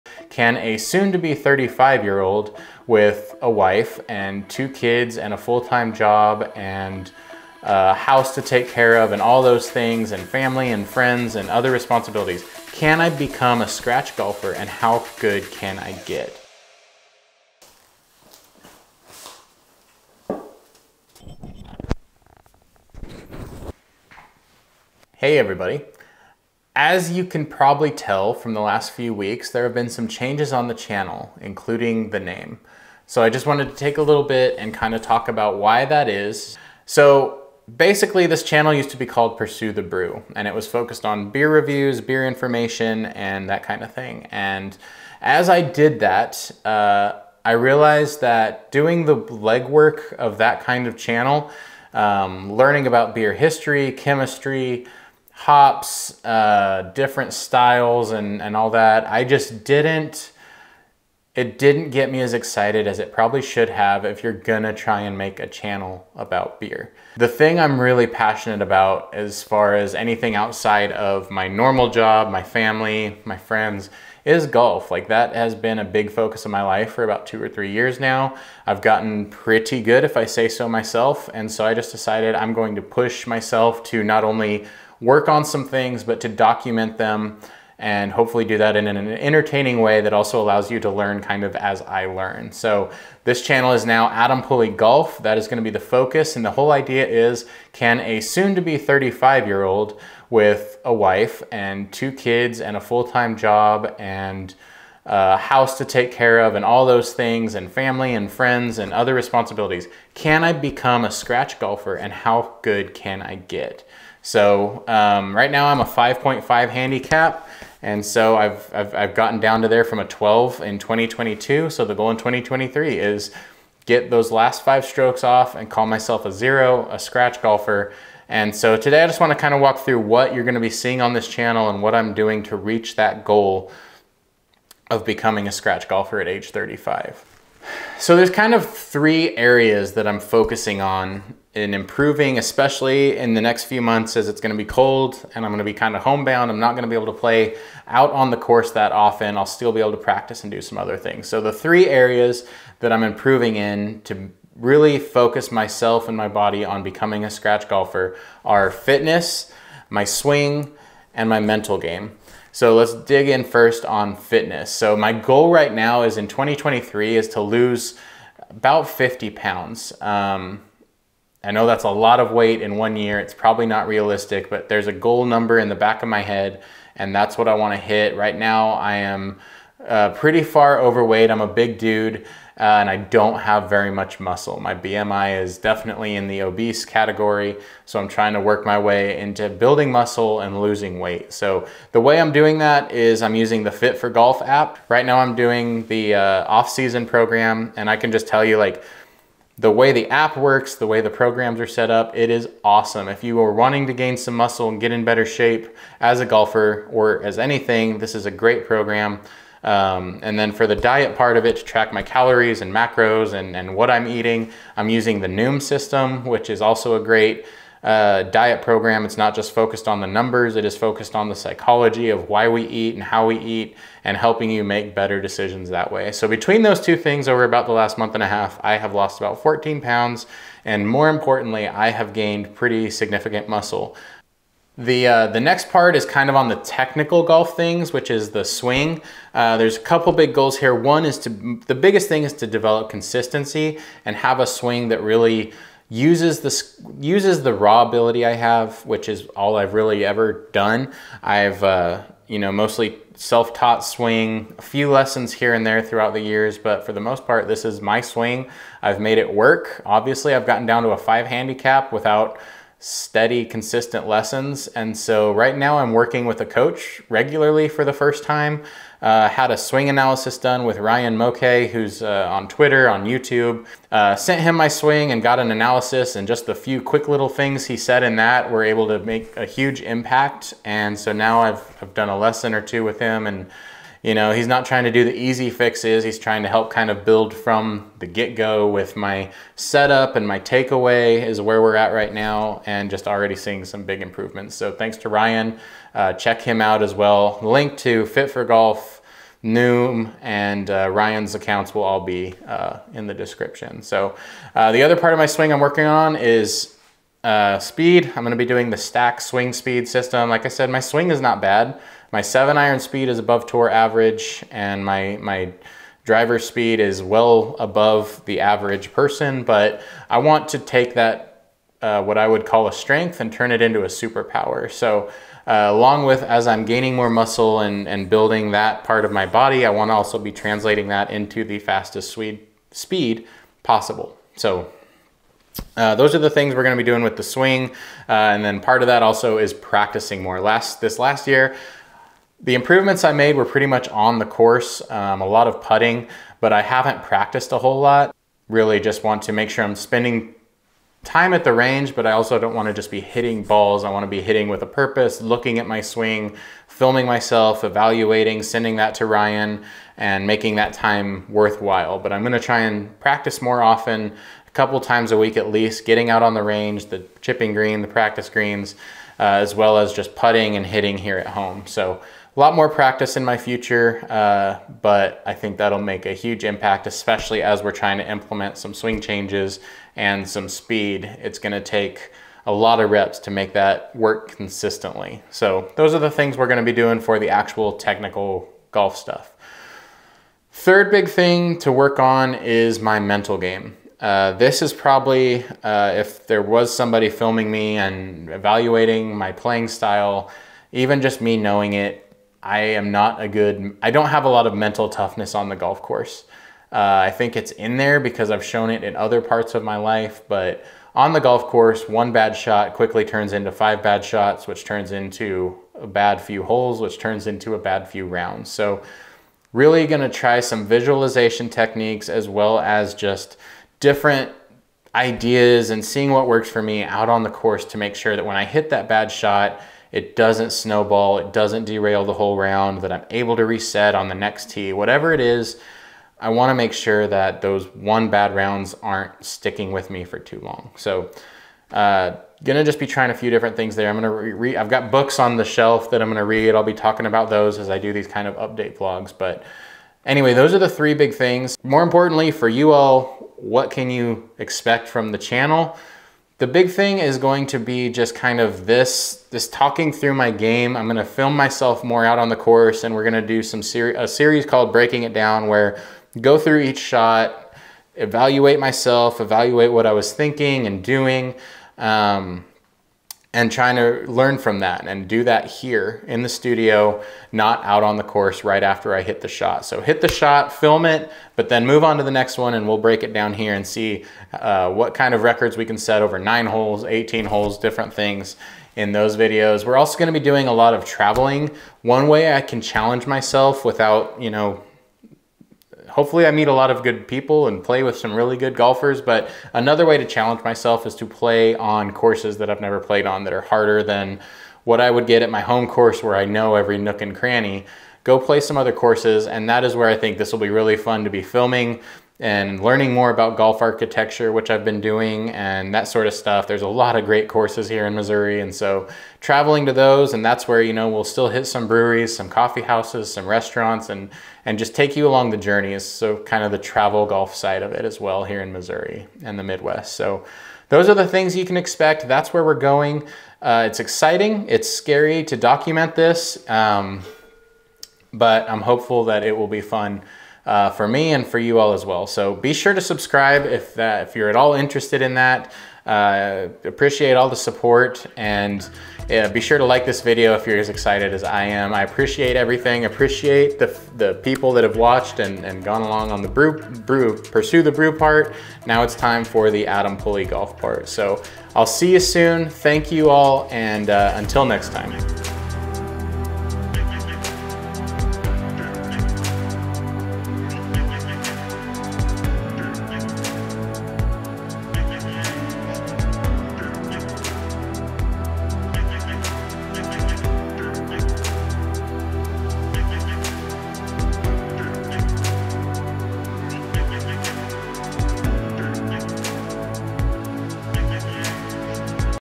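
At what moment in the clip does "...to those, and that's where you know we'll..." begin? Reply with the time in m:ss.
8:39.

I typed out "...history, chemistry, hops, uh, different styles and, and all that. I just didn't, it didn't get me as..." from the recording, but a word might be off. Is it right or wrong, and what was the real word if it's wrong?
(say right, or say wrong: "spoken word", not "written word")
right.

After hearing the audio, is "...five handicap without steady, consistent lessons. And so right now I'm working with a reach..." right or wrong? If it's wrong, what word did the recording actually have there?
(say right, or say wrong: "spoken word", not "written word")
wrong: "coach", not "reach".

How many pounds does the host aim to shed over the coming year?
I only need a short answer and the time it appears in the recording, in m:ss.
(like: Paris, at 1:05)
50, at 2:48.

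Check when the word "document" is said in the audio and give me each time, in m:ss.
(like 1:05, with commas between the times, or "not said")
1:26, 8:55.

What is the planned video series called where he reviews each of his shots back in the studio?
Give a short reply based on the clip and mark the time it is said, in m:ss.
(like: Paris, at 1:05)
Breaking It Down, at 7:44.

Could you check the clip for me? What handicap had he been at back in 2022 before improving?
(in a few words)
12.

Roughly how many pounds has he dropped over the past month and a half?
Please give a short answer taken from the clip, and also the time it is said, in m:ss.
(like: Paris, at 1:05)
14, at 3:49.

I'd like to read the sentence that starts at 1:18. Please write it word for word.
I've gotten pretty good if I say so myself.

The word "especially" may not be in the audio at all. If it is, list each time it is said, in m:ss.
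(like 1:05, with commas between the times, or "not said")
2:22, 6:16.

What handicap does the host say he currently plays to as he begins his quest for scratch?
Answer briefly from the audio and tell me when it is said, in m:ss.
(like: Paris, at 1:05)
5.5, at 1:55.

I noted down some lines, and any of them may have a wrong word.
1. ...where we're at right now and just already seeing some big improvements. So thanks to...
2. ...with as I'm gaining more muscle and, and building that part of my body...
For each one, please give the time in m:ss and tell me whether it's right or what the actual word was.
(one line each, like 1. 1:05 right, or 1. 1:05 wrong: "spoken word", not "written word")
1. 4:51 right
2. 5:26 right.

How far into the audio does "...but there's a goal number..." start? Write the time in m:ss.
2:54.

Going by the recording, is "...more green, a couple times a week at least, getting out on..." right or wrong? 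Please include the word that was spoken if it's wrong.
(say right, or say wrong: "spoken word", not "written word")
wrong: "often", not "green".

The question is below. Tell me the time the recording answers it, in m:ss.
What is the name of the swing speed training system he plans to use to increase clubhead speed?
5:08.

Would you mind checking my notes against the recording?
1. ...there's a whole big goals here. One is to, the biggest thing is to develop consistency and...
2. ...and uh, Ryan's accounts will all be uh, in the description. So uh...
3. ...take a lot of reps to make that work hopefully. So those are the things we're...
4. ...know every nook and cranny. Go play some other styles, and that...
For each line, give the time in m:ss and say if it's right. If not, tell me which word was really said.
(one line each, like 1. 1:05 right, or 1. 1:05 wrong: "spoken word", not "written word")
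1. 3:59 wrong: "couple", not "whole"
2. 5:00 right
3. 6:21 wrong: "consistently", not "hopefully"
4. 8:26 wrong: "courses", not "styles".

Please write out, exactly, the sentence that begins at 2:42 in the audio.
So let's dig in first on fitness.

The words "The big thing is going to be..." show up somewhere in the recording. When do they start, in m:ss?
7:36.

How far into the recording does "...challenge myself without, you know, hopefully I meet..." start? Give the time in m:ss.
8:12.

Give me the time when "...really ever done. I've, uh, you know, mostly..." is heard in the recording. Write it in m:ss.
4:09.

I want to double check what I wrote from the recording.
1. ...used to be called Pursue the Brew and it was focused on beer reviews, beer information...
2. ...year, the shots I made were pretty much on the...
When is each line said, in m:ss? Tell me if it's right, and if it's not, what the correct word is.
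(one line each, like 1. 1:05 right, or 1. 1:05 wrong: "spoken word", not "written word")
1. 0:38 right
2. 5:41 wrong: "improvements", not "shots".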